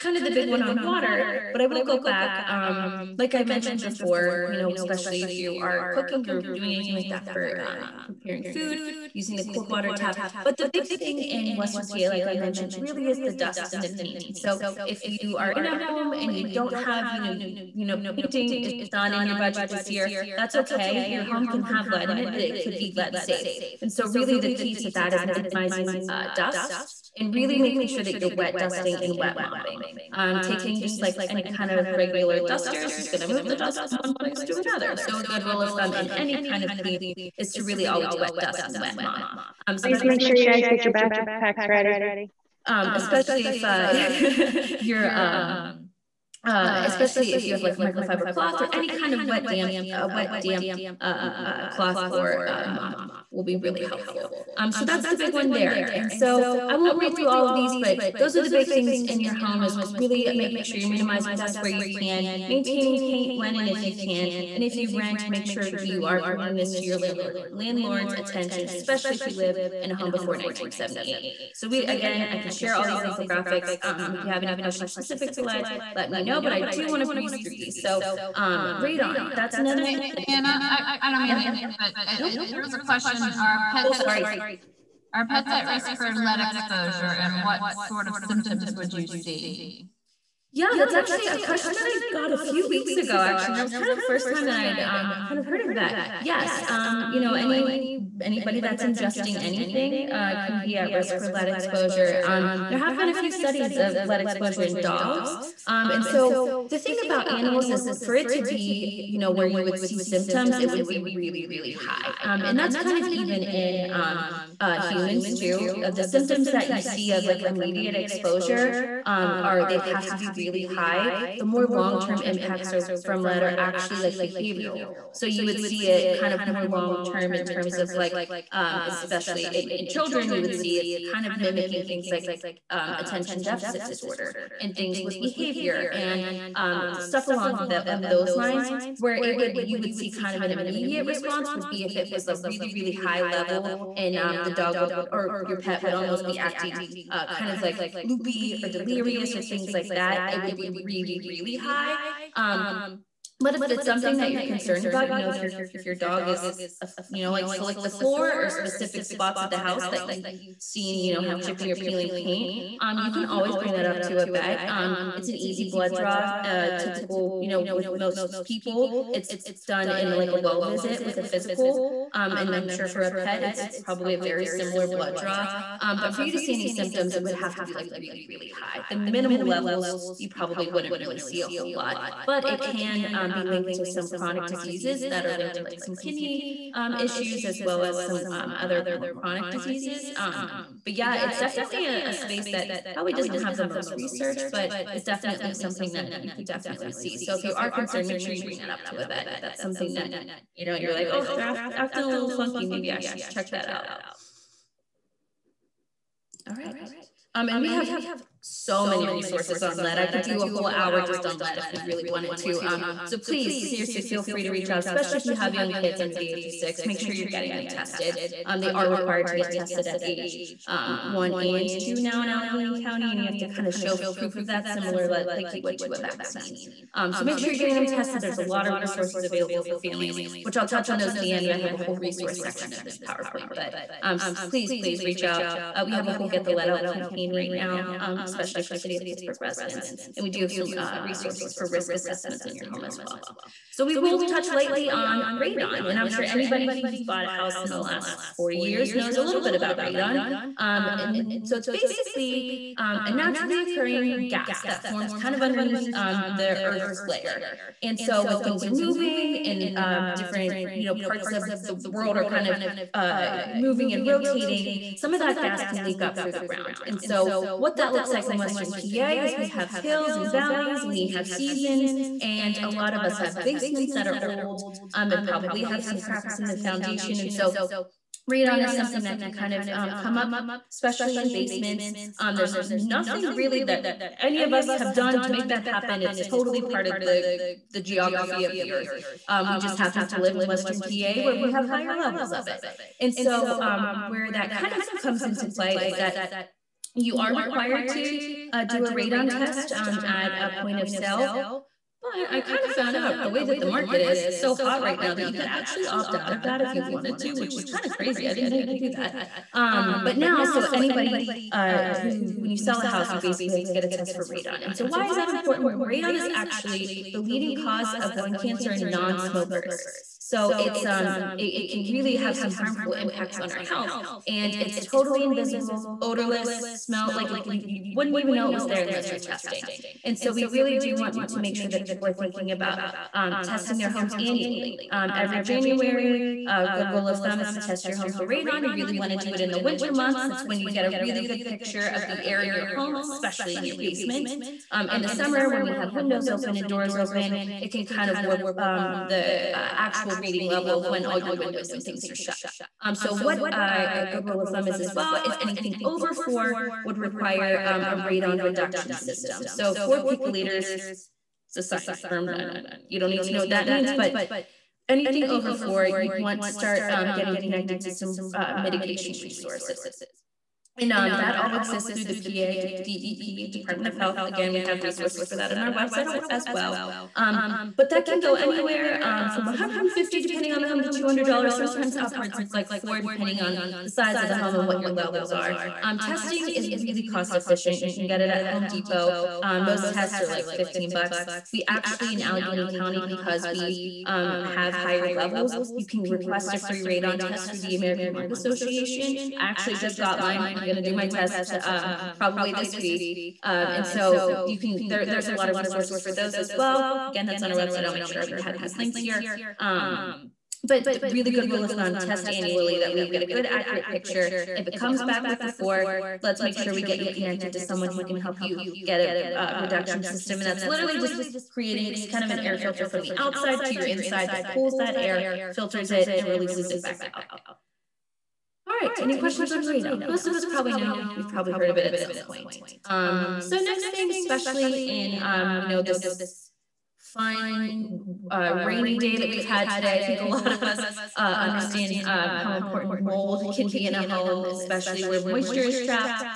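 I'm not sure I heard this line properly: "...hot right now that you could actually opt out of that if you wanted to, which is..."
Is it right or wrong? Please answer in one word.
right.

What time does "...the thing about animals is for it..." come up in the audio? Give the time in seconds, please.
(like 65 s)
106 s.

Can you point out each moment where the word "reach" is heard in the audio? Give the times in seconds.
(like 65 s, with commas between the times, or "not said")
214 s, 235 s.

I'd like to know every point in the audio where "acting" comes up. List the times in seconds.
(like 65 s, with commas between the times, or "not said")
146 s, 201 s.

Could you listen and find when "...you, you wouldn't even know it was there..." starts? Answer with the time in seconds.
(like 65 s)
327 s.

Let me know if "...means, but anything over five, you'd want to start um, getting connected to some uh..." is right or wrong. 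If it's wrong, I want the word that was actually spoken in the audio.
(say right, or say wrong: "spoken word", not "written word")
wrong: "four", not "five".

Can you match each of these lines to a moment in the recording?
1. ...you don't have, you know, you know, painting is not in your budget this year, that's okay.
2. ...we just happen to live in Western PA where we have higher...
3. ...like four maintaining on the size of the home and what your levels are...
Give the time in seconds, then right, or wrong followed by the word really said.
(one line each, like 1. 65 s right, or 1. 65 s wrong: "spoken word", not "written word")
1. 16 s right
2. 289 s right
3. 382 s wrong: "depending", not "maintaining".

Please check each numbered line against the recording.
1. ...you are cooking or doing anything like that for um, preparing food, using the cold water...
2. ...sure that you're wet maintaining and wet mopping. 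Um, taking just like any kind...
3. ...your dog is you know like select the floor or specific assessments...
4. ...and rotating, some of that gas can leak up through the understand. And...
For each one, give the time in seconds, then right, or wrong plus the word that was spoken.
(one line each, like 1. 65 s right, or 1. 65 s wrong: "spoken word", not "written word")
1. 5 s right
2. 27 s wrong: "dusting", not "maintaining"
3. 155 s wrong: "spots", not "assessments"
4. 263 s wrong: "ground", not "understand".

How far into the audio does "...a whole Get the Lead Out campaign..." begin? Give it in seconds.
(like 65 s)
236 s.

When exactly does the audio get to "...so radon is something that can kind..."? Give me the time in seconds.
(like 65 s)
277 s.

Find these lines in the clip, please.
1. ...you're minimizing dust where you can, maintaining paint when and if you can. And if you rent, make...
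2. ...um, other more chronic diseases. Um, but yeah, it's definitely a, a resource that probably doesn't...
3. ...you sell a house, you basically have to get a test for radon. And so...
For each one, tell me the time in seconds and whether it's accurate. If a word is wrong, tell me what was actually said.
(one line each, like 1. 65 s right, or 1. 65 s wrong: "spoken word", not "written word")
1. 60 s right
2. 188 s wrong: "space", not "resource"
3. 312 s right.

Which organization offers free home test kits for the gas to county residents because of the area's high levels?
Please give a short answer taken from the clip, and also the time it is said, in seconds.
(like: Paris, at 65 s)
American Lung Association, at 397 s.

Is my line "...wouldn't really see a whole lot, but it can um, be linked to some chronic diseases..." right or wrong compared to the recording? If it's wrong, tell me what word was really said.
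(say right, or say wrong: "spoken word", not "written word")
right.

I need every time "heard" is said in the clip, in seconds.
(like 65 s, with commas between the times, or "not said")
95 s, 431 s.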